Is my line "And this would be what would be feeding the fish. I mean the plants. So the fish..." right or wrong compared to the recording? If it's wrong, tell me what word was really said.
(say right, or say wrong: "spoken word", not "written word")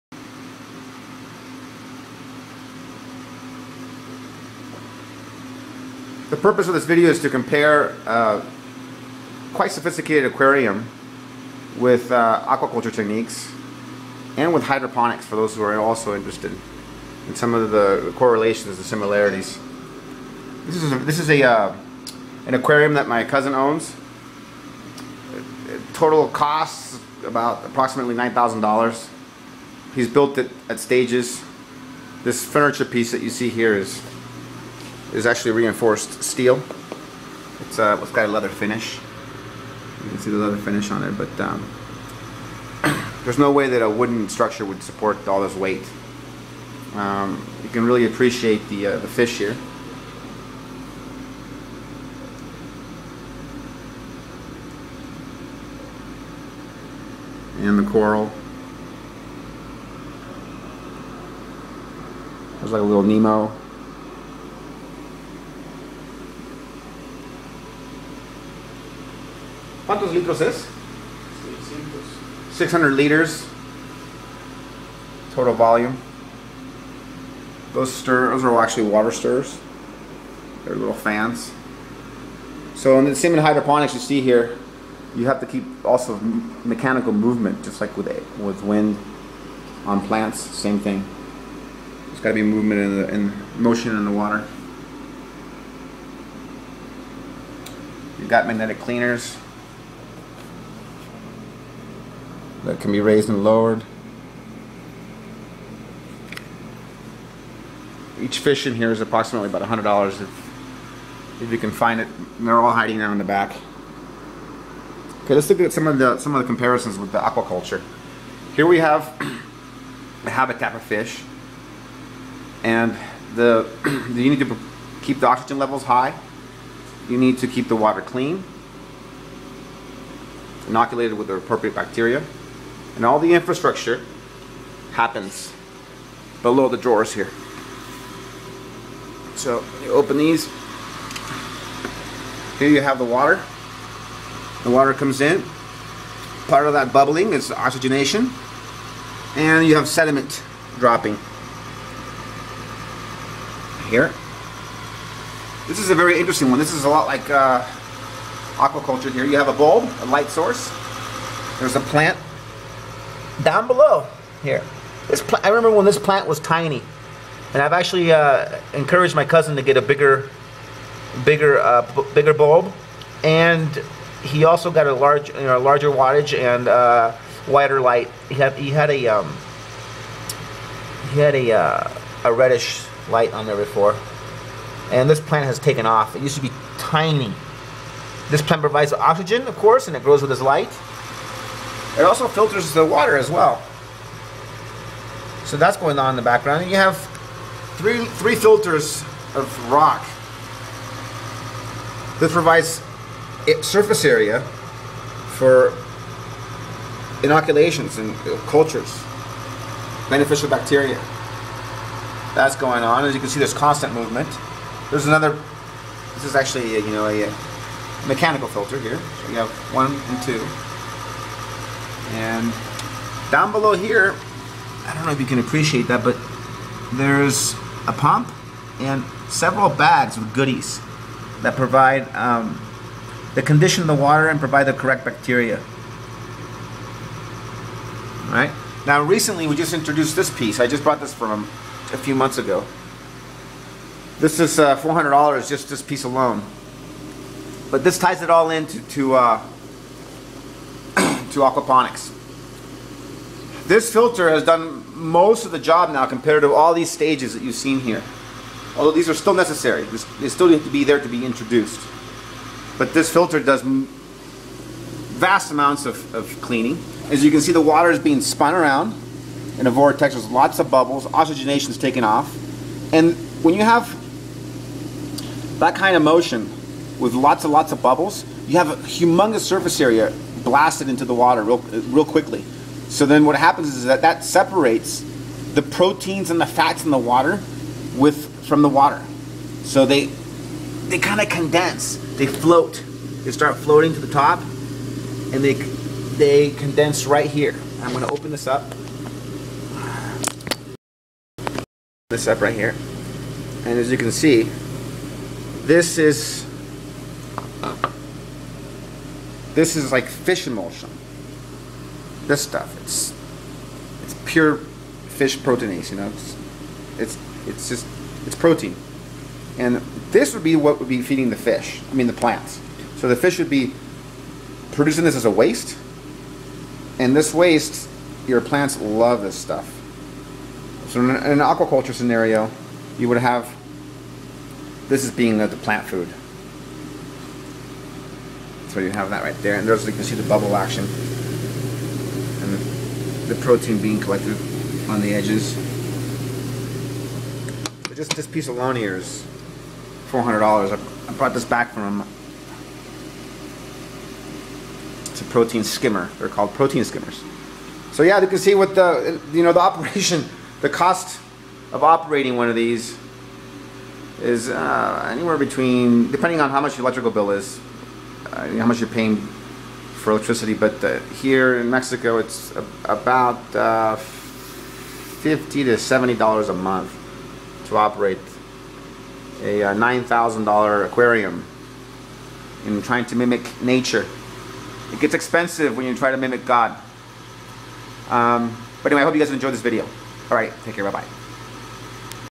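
right.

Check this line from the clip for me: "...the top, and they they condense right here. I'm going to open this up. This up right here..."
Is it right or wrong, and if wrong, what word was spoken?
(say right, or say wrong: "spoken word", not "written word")
right.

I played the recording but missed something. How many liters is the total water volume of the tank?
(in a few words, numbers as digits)
600.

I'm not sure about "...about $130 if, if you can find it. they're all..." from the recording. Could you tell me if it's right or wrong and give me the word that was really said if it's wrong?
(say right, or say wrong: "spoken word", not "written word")
wrong: "100", not "130".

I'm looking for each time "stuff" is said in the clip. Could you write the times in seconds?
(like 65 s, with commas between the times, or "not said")
312 s, 329 s.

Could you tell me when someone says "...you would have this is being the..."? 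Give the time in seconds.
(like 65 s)
332 s.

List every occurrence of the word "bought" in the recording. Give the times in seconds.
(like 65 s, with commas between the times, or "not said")
240 s.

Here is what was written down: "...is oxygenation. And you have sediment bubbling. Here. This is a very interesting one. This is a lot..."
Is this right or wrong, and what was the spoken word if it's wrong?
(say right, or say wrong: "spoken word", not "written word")
wrong: "dropping", not "bubbling".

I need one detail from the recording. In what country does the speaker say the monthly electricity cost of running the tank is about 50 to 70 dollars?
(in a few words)
Mexico.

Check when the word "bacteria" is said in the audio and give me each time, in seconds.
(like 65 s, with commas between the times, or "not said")
131 s, 210 s, 235 s.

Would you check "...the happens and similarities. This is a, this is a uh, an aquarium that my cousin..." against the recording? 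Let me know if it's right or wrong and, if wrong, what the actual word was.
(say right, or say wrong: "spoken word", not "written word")
wrong: "correlations", not "happens".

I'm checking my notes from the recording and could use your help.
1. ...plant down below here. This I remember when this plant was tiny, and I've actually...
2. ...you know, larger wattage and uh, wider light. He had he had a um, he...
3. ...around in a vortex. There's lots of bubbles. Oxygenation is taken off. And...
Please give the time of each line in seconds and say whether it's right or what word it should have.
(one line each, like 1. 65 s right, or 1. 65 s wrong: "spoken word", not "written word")
1. 161 s right
2. 175 s right
3. 268 s right.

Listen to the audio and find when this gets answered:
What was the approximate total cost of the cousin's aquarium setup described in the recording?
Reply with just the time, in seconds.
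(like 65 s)
28 s.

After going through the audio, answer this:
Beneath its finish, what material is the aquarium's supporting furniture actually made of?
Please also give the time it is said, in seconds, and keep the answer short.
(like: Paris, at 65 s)
Reinforced steel, at 35 s.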